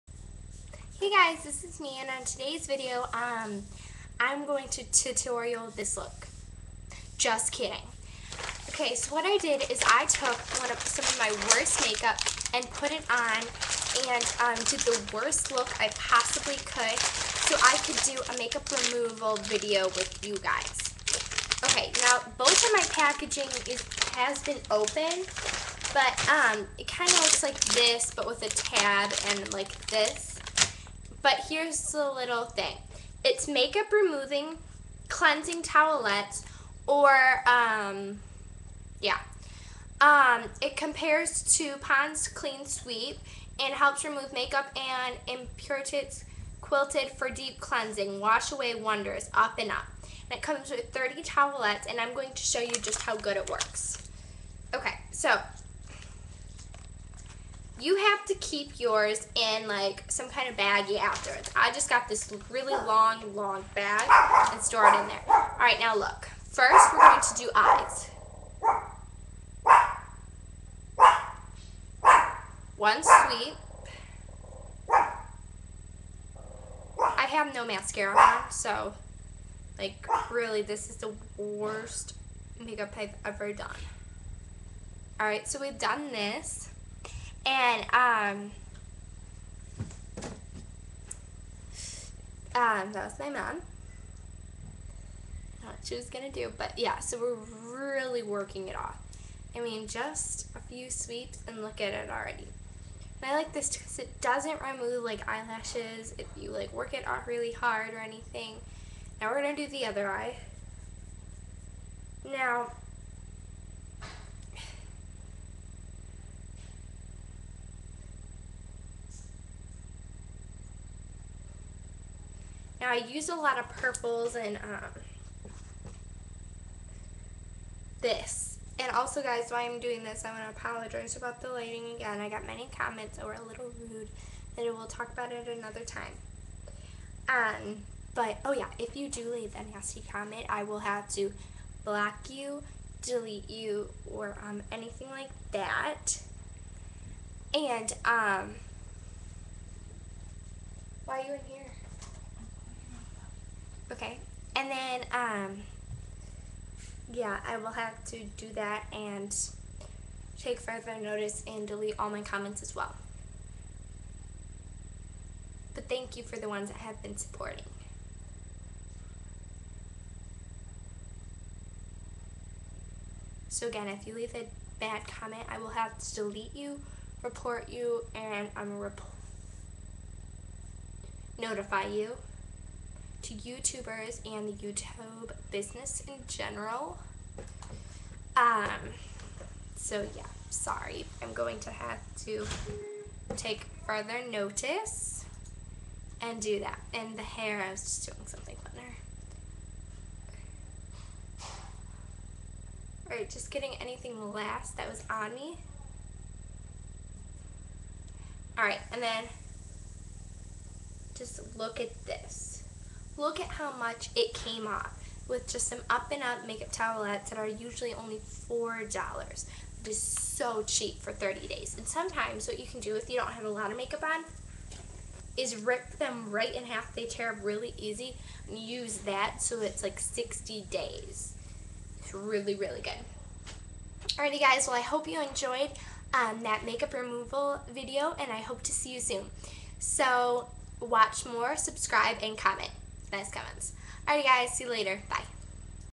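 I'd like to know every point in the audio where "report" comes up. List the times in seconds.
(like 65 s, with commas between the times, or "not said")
177 s.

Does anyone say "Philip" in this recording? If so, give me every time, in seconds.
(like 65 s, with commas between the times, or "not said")
not said.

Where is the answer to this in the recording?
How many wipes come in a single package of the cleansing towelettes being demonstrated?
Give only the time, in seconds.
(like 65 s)
50 s.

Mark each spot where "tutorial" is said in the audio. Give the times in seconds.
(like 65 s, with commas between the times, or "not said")
4 s.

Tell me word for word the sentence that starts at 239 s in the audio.
So watch more, subscribe, and comment nice comments.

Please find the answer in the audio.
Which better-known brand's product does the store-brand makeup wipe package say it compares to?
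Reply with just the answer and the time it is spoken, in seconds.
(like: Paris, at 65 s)
Pond's Clean Sweep, at 41 s.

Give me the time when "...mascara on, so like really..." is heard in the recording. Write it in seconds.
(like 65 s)
77 s.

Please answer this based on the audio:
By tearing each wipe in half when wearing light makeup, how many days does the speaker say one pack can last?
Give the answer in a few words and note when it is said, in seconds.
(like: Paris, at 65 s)
60 days, at 229 s.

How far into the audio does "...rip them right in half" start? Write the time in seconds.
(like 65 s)
225 s.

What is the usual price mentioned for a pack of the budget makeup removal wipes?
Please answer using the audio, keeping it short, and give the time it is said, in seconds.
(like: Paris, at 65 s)
$4, at 218 s.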